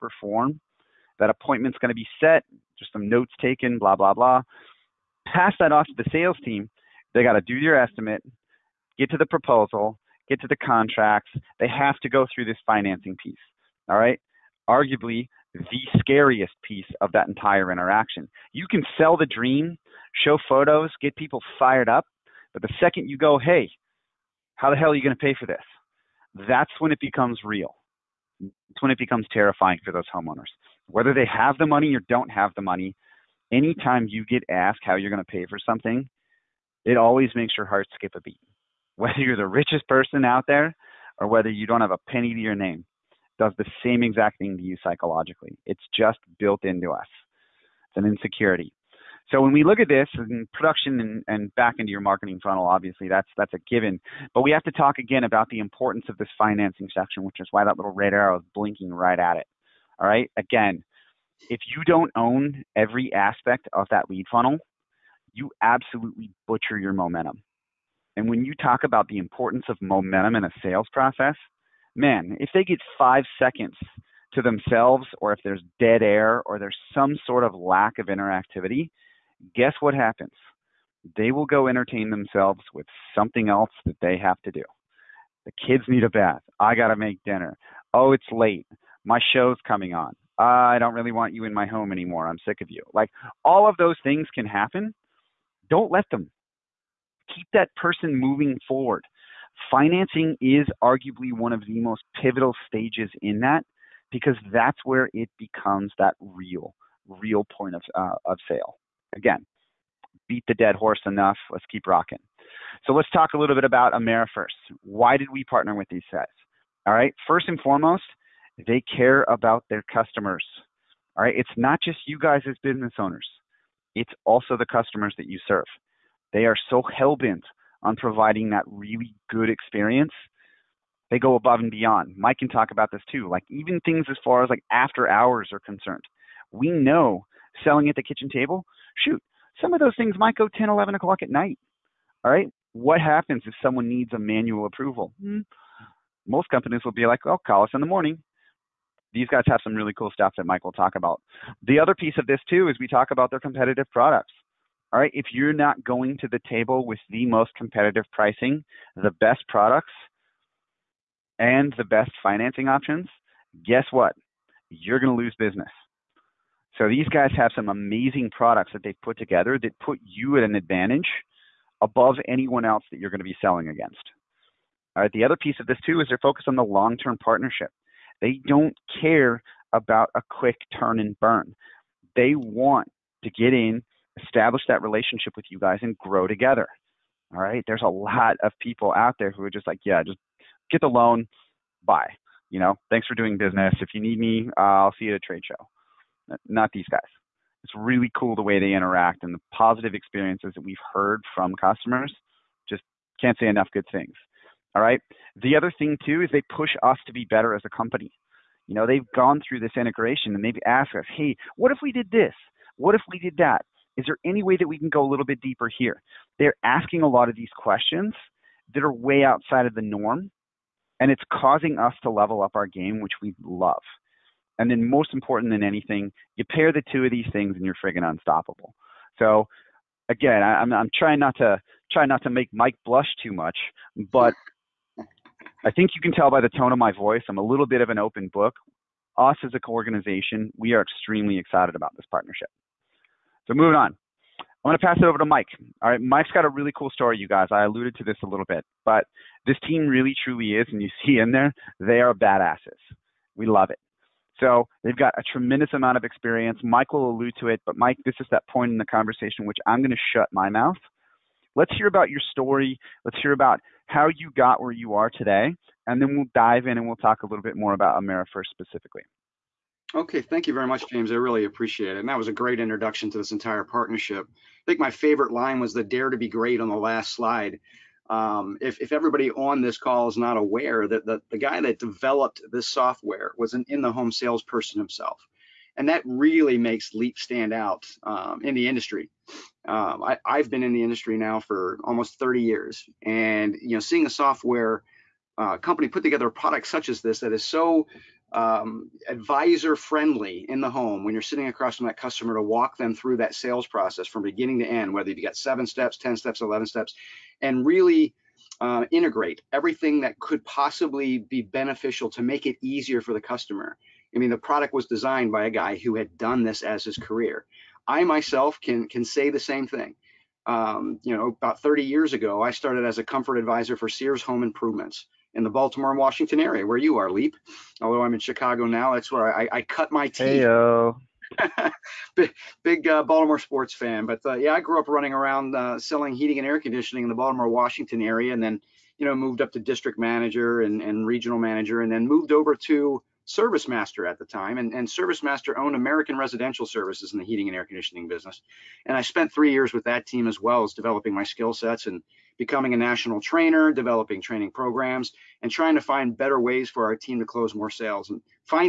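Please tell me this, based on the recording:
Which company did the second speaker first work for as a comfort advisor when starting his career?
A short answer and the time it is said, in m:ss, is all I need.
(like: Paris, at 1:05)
Sears Home Improvements, at 5:23.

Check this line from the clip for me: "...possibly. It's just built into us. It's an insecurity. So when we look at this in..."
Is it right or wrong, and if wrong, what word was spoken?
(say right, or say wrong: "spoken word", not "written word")
wrong: "psychologically", not "possibly".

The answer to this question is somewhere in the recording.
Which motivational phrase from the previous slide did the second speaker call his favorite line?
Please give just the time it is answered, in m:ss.
4:35.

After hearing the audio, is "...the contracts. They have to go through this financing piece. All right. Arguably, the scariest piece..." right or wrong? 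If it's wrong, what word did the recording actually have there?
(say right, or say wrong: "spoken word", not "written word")
right.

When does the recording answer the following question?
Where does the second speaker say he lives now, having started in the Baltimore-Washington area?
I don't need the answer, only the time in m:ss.
5:28.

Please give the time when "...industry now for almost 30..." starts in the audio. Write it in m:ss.
4:50.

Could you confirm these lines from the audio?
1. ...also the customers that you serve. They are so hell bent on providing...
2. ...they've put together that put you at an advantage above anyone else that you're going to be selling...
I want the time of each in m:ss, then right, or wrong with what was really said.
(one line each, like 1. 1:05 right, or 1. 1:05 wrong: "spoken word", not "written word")
1. 2:04 right
2. 2:48 right.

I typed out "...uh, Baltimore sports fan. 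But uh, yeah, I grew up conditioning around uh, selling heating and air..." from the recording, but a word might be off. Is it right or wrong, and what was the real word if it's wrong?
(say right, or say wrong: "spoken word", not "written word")
wrong: "running", not "conditioning".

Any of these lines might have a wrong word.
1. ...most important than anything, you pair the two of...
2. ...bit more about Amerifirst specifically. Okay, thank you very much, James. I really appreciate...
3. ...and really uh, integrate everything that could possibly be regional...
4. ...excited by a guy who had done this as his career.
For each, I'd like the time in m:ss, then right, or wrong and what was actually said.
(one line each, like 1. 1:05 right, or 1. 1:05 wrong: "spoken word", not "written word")
1. 3:44 right
2. 4:27 right
3. 5:07 wrong: "beneficial", not "regional"
4. 5:14 wrong: "designed", not "excited".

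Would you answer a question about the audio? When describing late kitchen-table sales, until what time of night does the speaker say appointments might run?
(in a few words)
10, 11 o'clock.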